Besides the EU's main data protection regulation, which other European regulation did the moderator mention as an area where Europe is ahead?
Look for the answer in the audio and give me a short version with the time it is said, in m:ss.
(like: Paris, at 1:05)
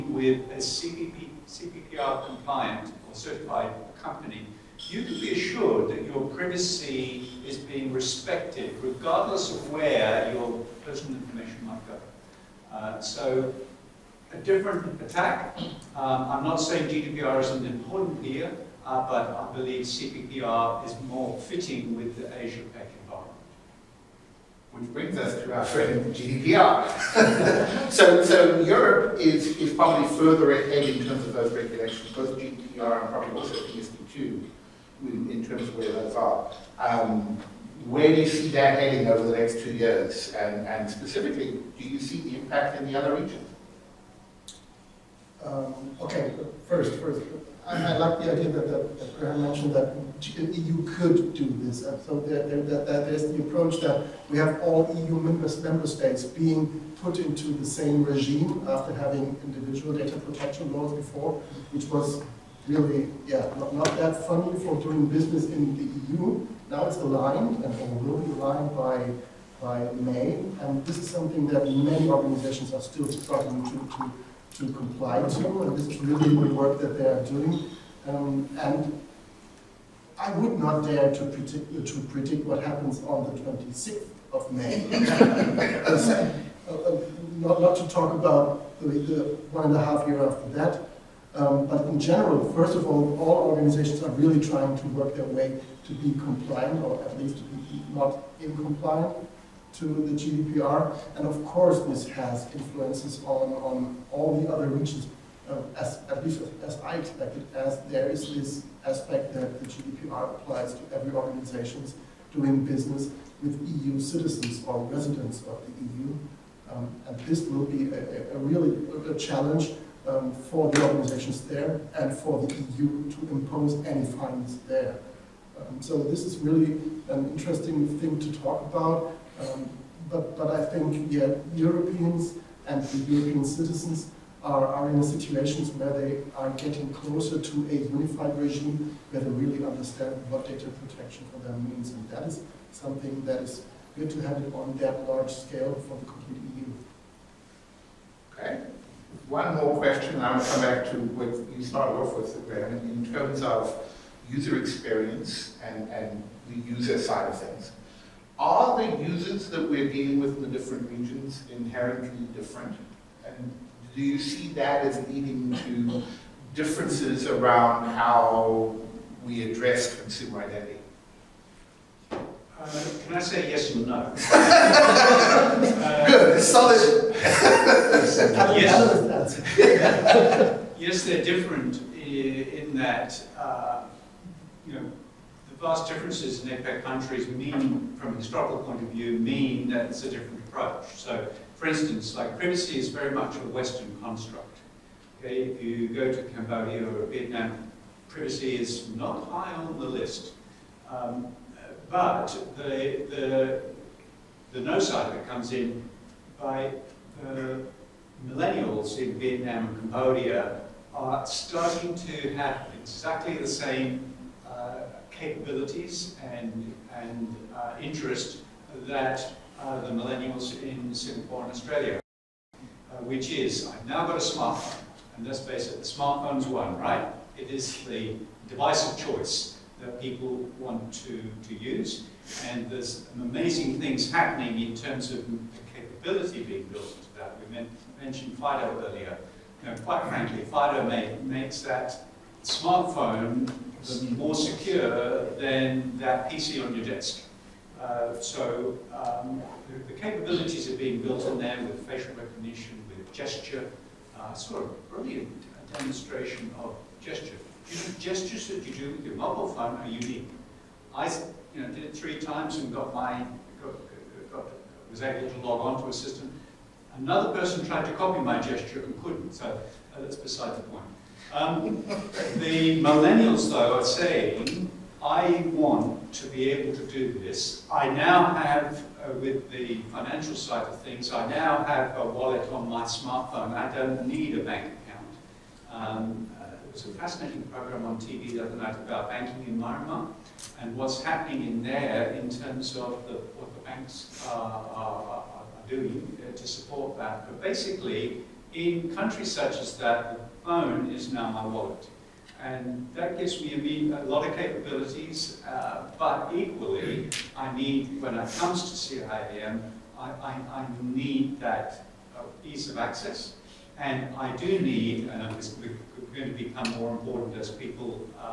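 PSD2, at 0:33.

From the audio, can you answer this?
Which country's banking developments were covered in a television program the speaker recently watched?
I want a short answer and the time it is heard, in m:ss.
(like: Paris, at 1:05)
Myanmar, at 4:49.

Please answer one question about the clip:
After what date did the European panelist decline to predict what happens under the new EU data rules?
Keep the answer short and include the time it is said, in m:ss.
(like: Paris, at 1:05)
26th of May, at 1:23.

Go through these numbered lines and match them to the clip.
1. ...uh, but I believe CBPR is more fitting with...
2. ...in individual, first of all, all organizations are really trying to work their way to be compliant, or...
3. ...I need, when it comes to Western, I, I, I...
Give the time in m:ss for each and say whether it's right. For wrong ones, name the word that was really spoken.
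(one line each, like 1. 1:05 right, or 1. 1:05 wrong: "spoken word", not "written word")
1. 0:18 right
2. 1:31 wrong: "general", not "individual"
3. 5:07 wrong: "CIAM", not "Western".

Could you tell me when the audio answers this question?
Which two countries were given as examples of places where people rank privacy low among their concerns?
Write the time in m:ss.
3:16.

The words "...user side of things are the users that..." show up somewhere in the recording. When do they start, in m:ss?
2:36.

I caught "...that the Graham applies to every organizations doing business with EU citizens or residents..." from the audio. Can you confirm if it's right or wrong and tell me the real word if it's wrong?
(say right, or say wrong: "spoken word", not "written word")
wrong: "GDPR", not "Graham".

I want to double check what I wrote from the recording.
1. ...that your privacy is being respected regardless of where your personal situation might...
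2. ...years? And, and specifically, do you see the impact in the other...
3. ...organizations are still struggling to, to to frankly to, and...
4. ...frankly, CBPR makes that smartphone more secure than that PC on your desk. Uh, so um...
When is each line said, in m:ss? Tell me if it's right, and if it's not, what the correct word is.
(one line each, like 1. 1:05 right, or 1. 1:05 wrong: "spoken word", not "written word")
1. 0:05 wrong: "information", not "situation"
2. 0:39 right
3. 1:12 wrong: "comply", not "frankly"
4. 4:00 wrong: "FIDO", not "CBPR".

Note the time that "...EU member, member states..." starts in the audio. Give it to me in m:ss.
0:54.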